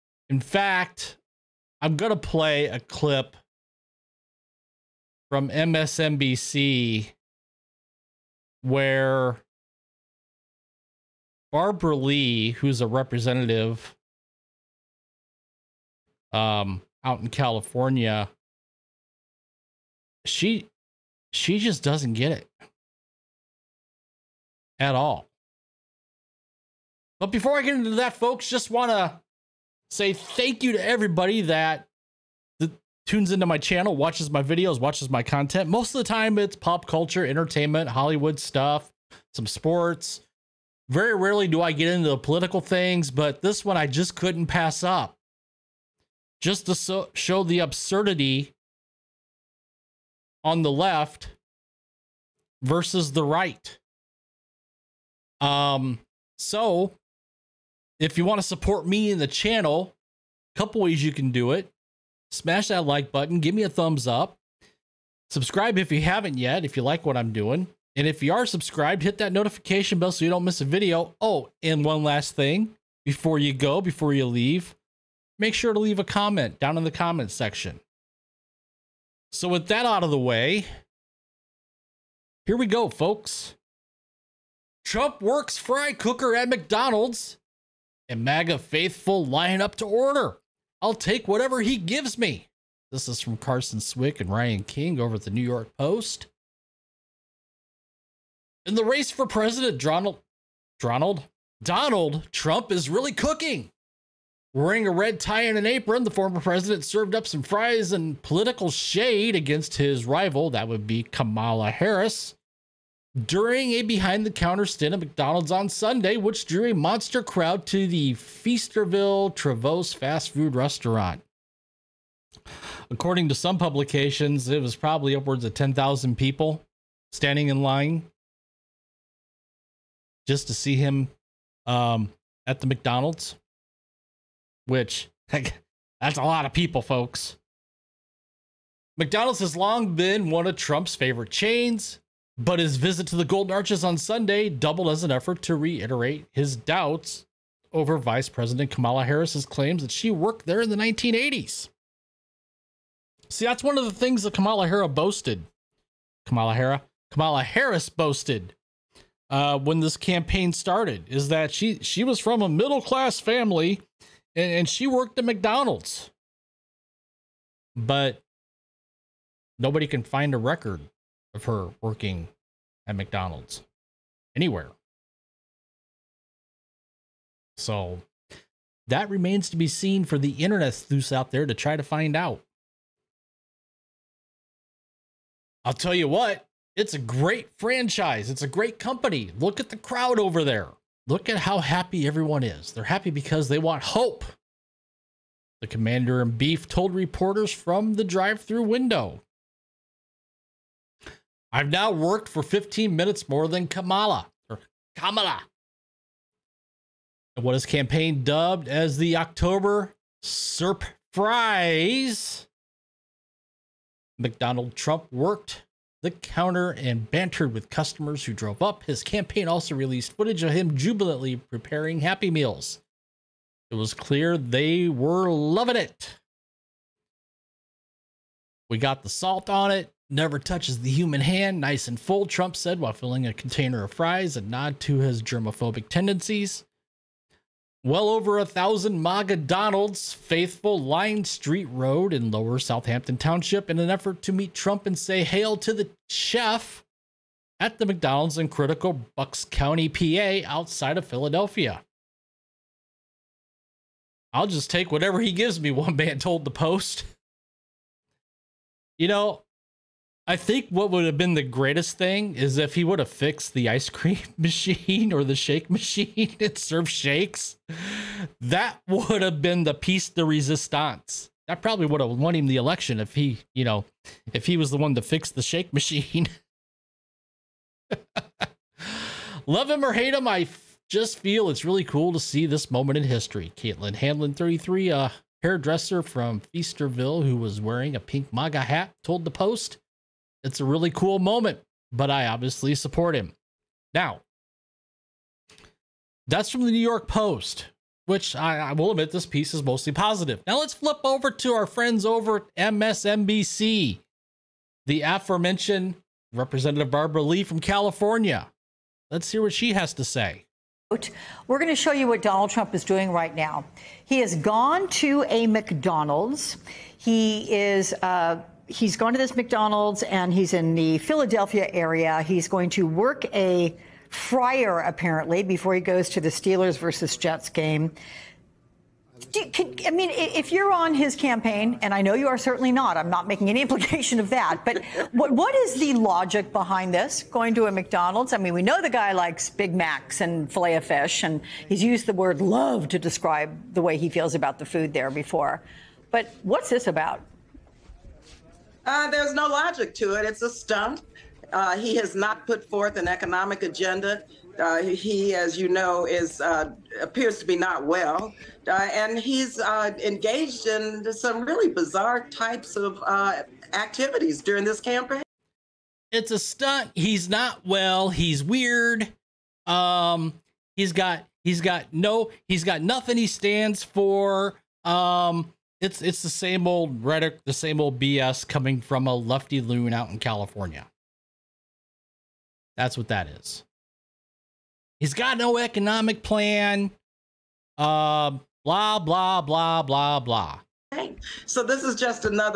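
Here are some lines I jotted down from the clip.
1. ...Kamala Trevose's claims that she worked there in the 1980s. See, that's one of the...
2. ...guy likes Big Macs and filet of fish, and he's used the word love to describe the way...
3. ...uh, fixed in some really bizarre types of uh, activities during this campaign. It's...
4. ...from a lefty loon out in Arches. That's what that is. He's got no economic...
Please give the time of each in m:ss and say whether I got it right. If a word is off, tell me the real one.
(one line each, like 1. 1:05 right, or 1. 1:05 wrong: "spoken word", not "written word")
1. 2:28 wrong: "Harris", not "Trevose"
2. 5:38 right
3. 5:59 wrong: "engaged", not "fixed"
4. 6:18 wrong: "California", not "Arches".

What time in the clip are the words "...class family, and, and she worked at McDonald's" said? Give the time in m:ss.
2:42.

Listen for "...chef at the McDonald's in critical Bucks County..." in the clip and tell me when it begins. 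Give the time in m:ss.
4:06.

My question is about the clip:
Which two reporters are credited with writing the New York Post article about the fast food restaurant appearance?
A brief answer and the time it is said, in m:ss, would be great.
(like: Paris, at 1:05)
Carson Swick and Ryan King, at 1:33.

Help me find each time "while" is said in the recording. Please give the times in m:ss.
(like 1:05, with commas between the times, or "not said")
3:52.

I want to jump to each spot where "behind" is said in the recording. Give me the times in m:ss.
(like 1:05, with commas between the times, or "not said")
1:53, 5:36.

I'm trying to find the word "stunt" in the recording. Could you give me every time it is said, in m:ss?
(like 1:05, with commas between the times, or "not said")
5:50, 6:06.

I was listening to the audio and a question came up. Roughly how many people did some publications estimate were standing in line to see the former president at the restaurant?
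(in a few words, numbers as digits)
10,000.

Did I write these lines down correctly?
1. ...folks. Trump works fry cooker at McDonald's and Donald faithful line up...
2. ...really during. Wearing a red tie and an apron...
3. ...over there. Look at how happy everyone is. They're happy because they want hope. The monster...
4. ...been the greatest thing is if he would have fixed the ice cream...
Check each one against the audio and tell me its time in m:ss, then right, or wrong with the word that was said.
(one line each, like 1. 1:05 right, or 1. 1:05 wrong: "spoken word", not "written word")
1. 1:22 wrong: "MAGA", not "Donald"
2. 1:42 wrong: "cooking", not "during"
3. 3:10 wrong: "commander", not "monster"
4. 4:21 right.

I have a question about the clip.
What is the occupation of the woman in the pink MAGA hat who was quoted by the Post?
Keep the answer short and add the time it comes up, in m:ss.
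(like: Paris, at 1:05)
Hairdresser, at 4:44.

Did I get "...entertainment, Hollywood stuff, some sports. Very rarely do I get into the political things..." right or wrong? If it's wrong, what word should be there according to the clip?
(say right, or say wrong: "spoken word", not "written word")
right.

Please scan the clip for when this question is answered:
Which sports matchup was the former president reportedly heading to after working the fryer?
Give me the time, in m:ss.
5:26.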